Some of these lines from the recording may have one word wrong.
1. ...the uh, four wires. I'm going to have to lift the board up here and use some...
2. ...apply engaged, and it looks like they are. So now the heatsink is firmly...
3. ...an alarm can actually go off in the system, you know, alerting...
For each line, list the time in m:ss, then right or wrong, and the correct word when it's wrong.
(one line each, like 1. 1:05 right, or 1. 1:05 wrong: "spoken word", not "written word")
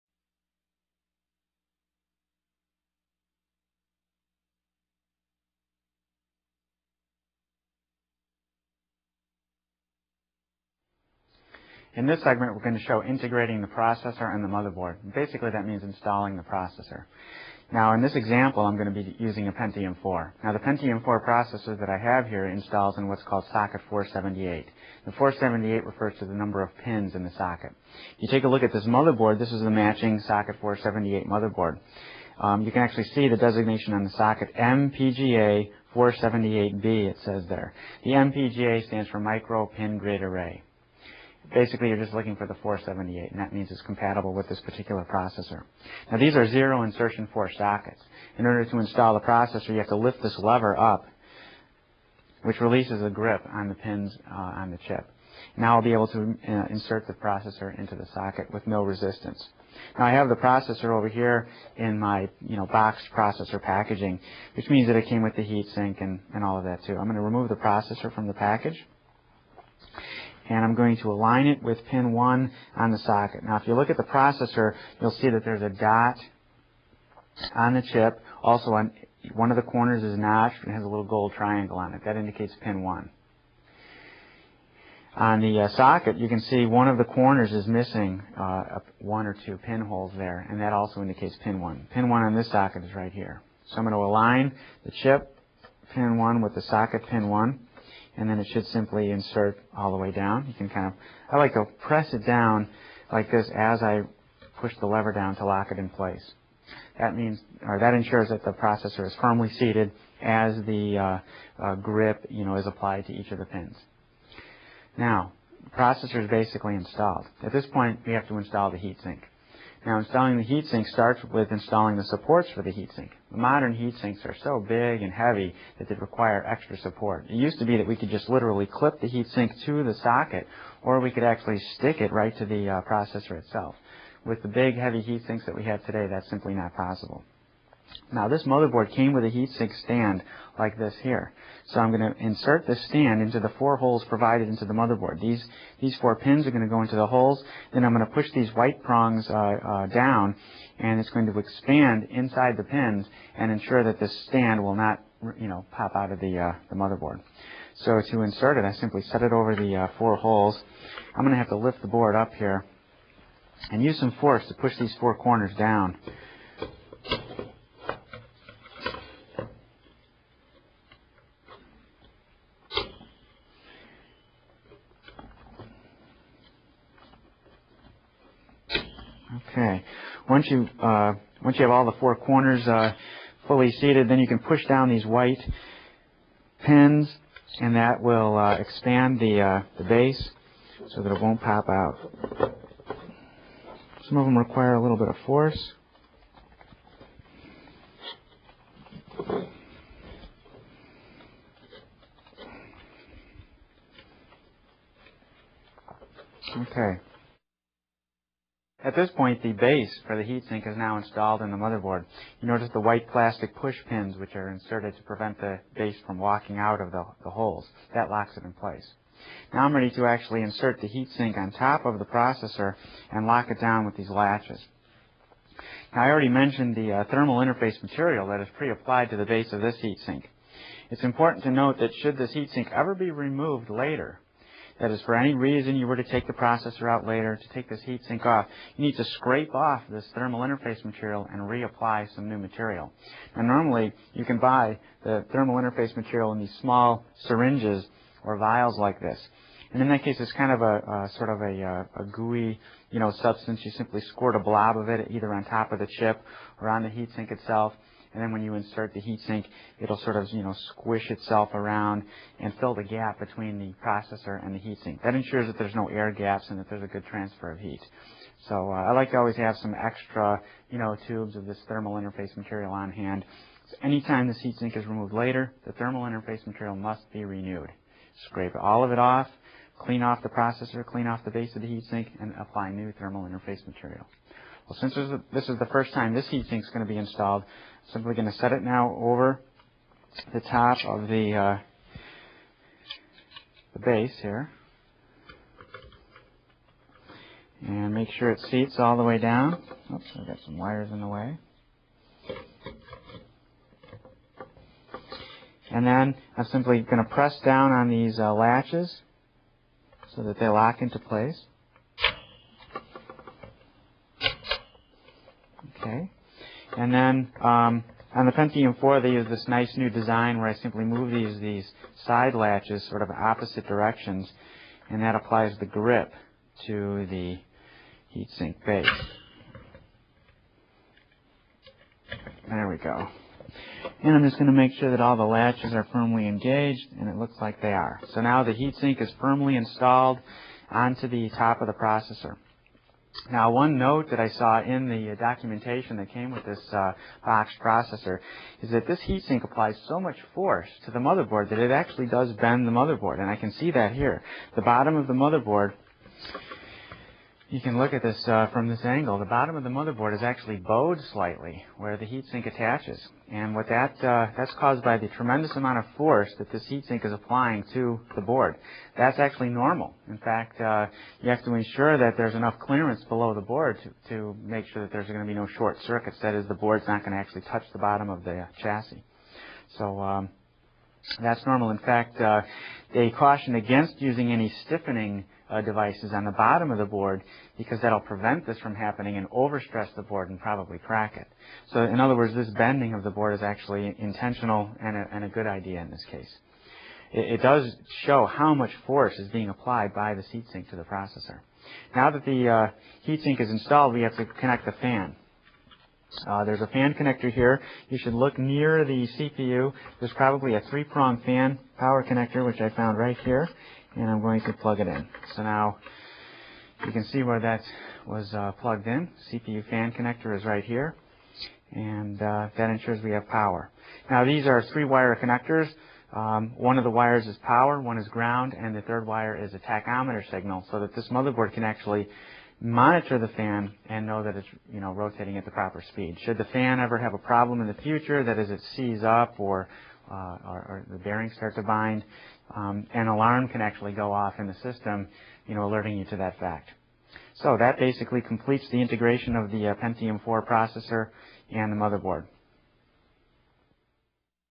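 1. 2:39 wrong: "holes", not "wires"
2. 5:35 wrong: "firmly", not "apply"
3. 7:22 right.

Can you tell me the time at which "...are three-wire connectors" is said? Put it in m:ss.
7:04.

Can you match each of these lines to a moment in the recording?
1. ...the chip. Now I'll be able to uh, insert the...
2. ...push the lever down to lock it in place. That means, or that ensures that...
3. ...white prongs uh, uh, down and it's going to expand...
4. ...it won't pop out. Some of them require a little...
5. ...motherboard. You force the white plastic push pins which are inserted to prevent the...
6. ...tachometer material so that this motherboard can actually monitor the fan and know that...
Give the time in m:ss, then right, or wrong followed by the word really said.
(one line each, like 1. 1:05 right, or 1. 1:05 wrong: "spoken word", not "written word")
1. 0:54 right
2. 1:44 right
3. 2:28 right
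4. 3:11 right
5. 3:31 wrong: "notice", not "force"
6. 7:09 wrong: "signal", not "material".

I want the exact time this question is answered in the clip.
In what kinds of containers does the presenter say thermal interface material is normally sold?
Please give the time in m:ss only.
4:07.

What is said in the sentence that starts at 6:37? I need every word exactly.
It, it, does show how much force is being applied by the heat sink to the processor.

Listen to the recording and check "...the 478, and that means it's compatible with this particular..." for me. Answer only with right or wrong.
right.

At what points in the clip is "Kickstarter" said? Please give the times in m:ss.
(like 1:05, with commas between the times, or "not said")
not said.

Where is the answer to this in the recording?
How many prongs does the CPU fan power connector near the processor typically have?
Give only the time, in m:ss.
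6:50.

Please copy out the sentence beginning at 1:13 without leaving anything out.
Now if you look at the processor, you'll see that there's a dot on the chip.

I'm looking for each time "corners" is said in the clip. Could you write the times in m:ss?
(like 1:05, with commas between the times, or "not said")
1:19, 1:27, 2:45, 3:02.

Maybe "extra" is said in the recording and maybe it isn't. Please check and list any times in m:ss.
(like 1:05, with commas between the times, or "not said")
2:06, 4:29.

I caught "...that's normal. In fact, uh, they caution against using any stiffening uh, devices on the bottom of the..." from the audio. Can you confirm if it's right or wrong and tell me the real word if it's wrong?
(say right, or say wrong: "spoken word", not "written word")
right.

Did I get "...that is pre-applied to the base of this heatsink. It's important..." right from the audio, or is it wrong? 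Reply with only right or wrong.
right.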